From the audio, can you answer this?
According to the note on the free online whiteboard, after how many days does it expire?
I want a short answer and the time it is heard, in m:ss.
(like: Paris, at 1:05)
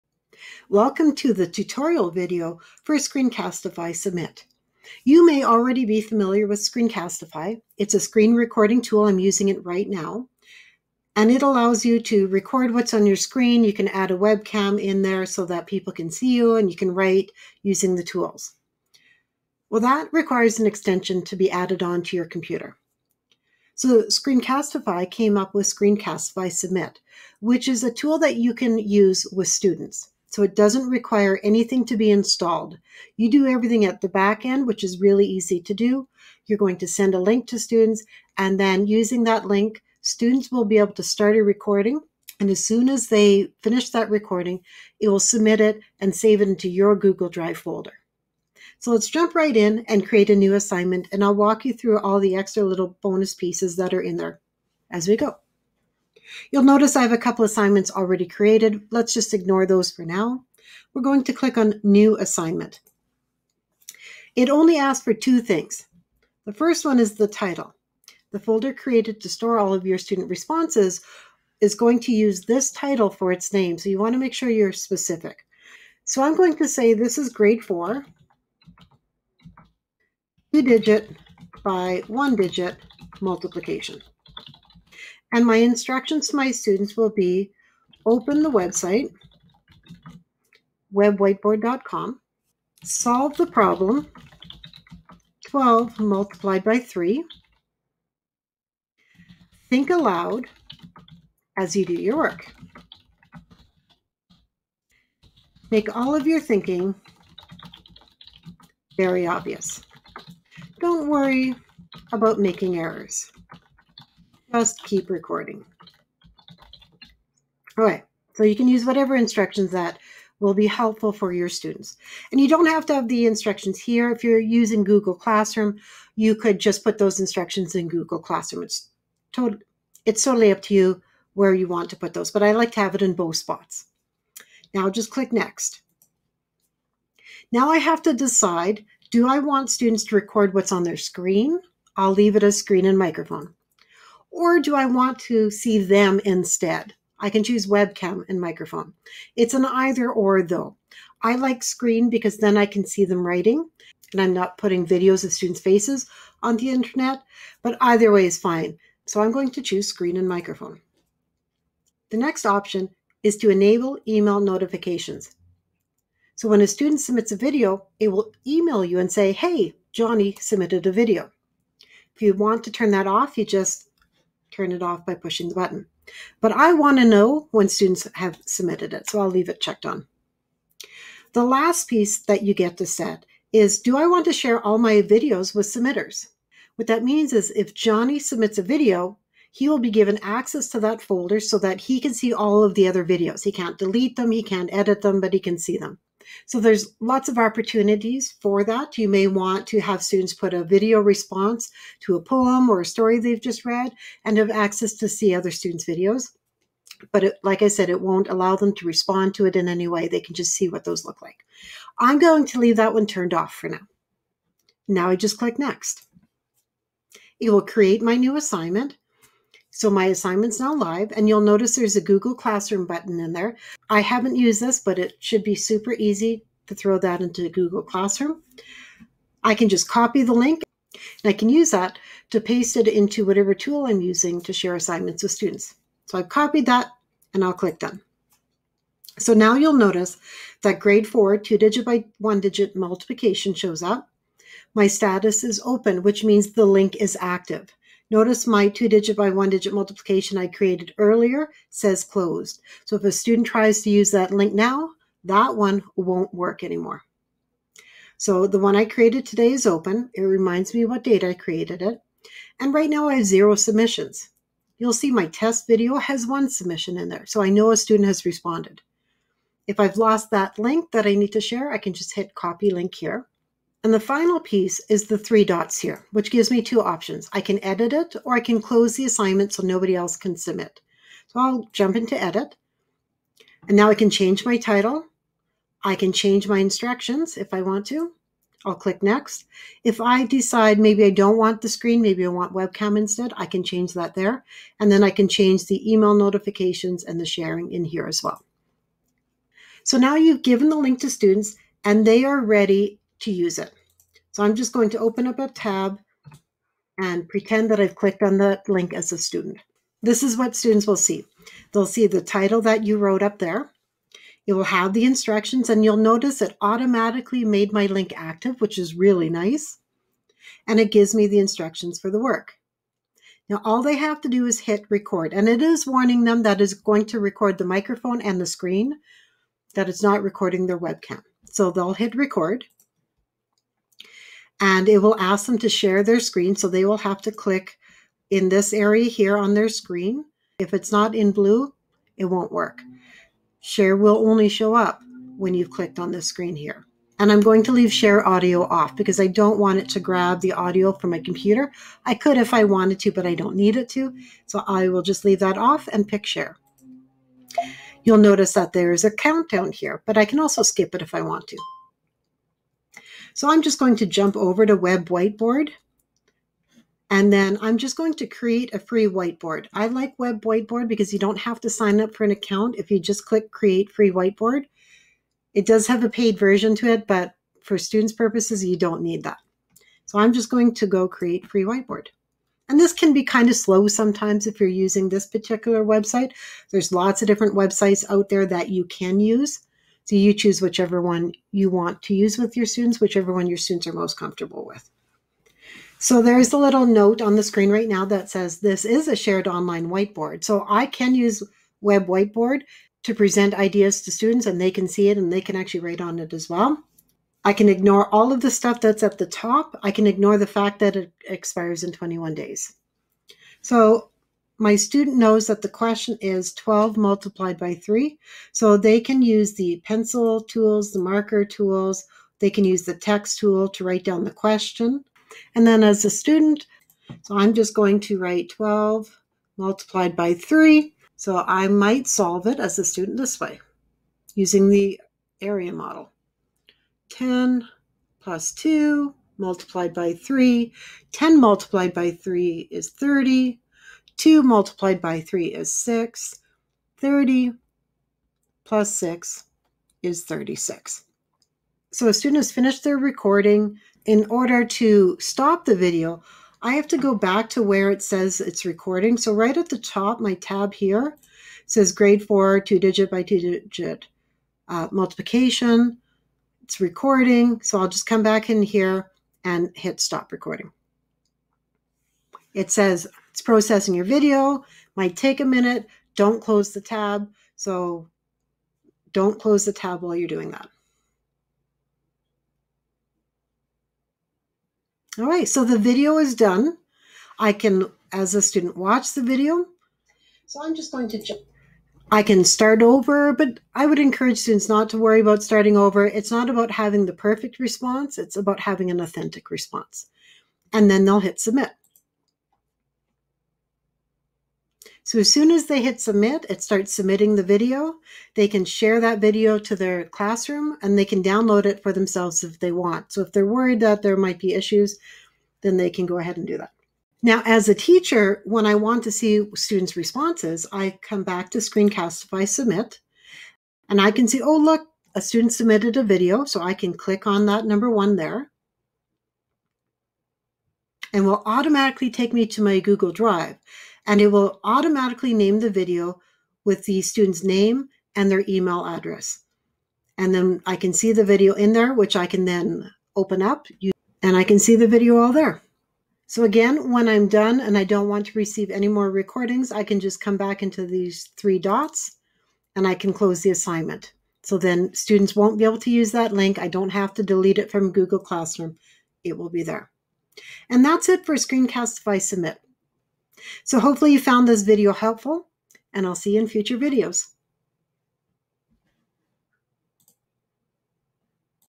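21, at 6:51.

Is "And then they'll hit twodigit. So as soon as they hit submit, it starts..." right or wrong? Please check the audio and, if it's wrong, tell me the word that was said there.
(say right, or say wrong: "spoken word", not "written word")
wrong: "submit", not "twodigit".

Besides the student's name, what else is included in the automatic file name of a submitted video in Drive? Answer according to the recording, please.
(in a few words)
email address.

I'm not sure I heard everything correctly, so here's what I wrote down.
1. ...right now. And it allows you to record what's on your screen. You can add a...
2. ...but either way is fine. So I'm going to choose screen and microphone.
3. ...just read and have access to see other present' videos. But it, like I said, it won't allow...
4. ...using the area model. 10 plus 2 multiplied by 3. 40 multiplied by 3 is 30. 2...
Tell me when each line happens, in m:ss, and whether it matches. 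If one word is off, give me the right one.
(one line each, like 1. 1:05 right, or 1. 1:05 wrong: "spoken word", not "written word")
1. 0:09 right
2. 2:37 right
3. 3:23 wrong: "students", not "present"
4. 7:14 wrong: "10", not "40".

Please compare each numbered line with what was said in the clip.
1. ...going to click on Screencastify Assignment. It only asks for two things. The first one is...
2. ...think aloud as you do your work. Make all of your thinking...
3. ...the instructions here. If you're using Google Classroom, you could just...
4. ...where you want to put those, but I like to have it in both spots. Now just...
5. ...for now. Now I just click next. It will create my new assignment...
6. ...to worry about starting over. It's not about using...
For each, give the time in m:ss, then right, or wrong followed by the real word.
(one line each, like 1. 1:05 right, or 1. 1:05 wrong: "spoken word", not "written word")
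1. 1:01 wrong: "New", not "Screencastify"
2. 1:39 right
3. 2:03 right
4. 2:11 right
5. 3:33 right
6. 8:14 wrong: "having", not "using".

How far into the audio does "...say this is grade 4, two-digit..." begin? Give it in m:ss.
1:16.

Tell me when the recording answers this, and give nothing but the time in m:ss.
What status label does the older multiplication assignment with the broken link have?
4:12.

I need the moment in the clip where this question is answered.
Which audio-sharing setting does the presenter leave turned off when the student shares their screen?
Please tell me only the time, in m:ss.
5:47.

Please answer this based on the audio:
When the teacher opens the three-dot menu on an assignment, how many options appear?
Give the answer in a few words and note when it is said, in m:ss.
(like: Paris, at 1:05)
2, at 4:36.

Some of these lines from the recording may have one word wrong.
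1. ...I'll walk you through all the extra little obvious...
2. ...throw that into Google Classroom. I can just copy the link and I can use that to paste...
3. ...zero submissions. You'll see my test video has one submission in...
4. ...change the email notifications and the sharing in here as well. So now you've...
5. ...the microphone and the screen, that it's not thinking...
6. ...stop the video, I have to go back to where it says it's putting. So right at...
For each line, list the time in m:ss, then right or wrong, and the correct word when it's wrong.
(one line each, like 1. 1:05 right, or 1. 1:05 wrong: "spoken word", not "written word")
1. 0:51 wrong: "bonus", not "obvious"
2. 3:46 right
3. 4:23 right
4. 4:55 right
5. 5:27 wrong: "recording", not "thinking"
6. 7:35 wrong: "recording", not "putting".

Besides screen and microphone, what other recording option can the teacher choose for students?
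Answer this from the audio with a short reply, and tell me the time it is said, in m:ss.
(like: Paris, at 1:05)
webcam and microphone, at 2:27.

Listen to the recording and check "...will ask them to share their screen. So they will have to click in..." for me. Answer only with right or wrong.
right.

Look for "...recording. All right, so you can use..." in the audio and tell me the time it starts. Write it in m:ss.
1:55.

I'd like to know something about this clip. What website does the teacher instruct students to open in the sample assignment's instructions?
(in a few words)
webwhiteboard.com.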